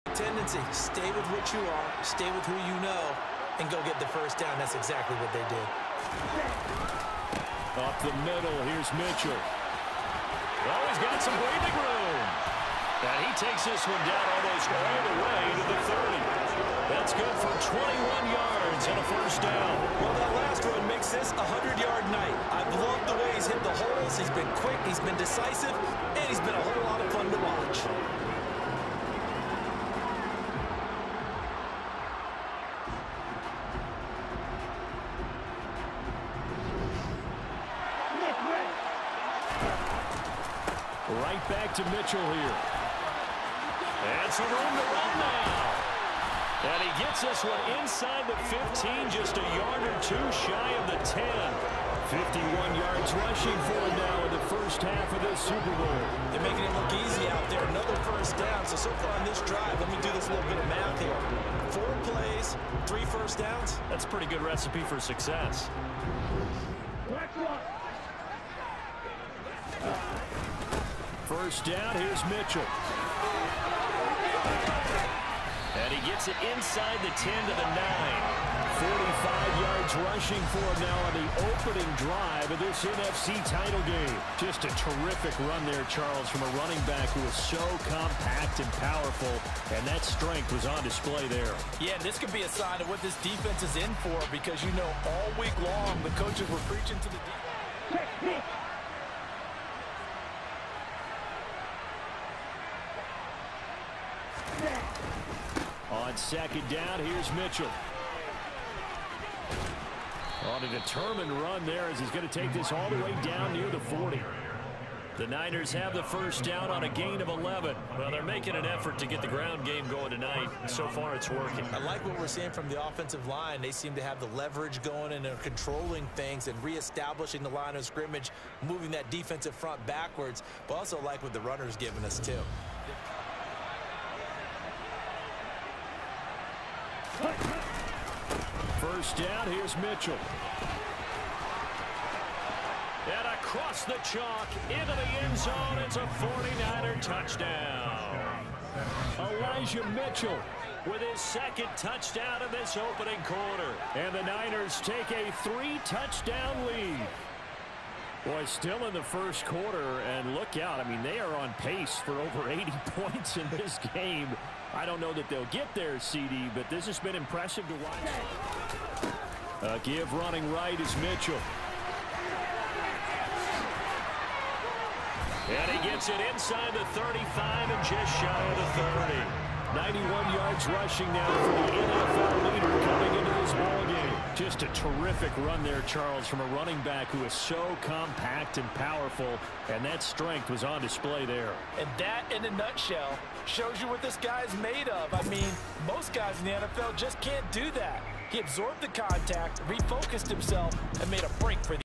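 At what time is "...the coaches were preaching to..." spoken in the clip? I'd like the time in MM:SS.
01:36.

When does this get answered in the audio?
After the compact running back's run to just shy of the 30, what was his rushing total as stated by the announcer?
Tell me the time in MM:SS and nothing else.
02:59.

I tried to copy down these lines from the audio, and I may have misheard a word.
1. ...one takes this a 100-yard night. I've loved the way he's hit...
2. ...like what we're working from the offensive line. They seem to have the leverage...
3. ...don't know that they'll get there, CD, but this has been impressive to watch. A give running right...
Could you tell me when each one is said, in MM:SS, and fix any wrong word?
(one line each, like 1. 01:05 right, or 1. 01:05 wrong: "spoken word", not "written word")
1. 00:20 wrong: "makes", not "takes"
2. 02:01 wrong: "seeing", not "working"
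3. 02:44 right.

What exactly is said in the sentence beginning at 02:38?
Boy, still in the first quarter, and look out.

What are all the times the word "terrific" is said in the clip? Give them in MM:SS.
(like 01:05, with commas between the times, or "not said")
01:24, 03:04.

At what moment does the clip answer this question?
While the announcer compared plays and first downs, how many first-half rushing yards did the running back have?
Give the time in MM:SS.
00:52.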